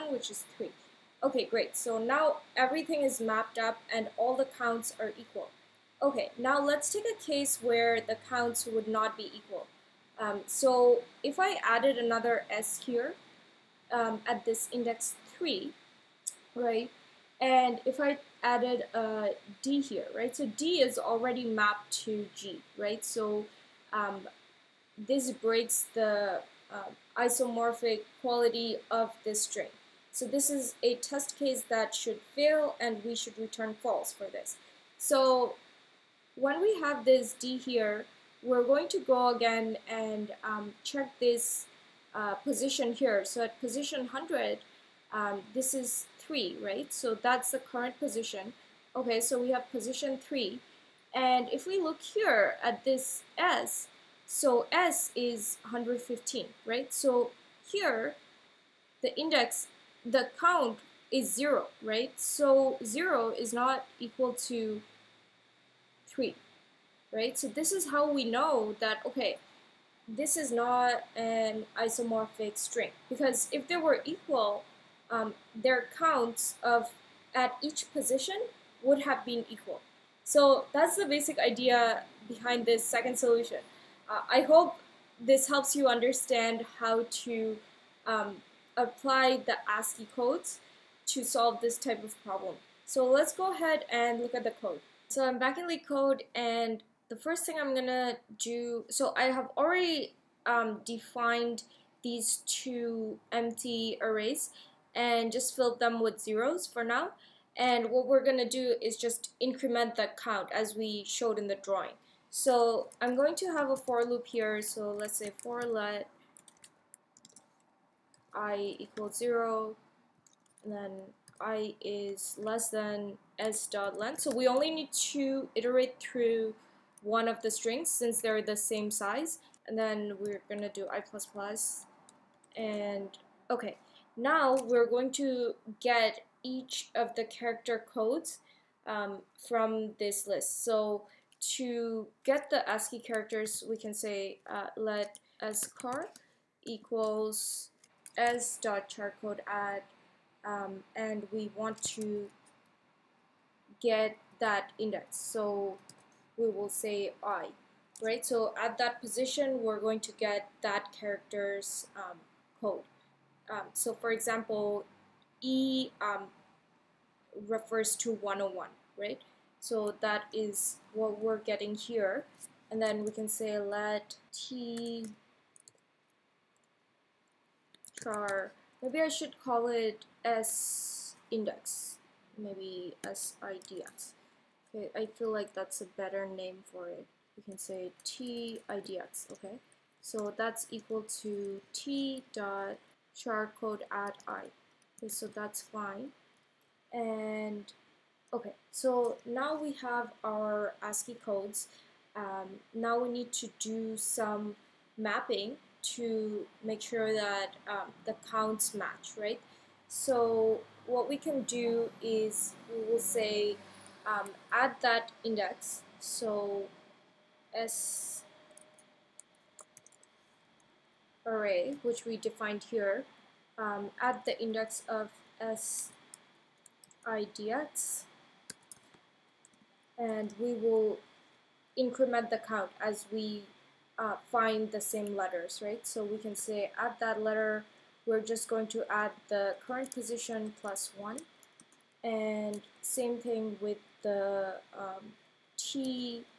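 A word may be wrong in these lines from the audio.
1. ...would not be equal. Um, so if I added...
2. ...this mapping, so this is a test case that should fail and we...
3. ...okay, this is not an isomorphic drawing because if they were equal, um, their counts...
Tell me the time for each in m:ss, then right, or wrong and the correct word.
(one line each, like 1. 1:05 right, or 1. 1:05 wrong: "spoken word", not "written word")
1. 0:08 right
2. 0:29 wrong: "string", not "mapping"
3. 1:09 wrong: "string", not "drawing".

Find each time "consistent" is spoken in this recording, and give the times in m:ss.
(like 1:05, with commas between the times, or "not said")
not said.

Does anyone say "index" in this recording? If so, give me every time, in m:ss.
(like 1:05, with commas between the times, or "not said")
0:14, 0:59, 2:34, 3:01, 3:35, 3:44.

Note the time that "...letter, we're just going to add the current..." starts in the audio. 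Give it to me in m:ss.
3:57.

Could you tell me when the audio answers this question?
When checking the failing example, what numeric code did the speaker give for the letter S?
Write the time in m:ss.
0:54.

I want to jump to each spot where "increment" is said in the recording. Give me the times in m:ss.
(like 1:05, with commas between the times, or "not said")
1:49, 3:51.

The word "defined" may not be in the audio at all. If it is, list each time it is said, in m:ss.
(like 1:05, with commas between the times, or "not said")
1:40, 3:42.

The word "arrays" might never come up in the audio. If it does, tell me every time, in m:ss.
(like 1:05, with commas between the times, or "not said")
1:44, 3:41.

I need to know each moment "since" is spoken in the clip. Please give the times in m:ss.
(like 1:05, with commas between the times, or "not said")
2:07.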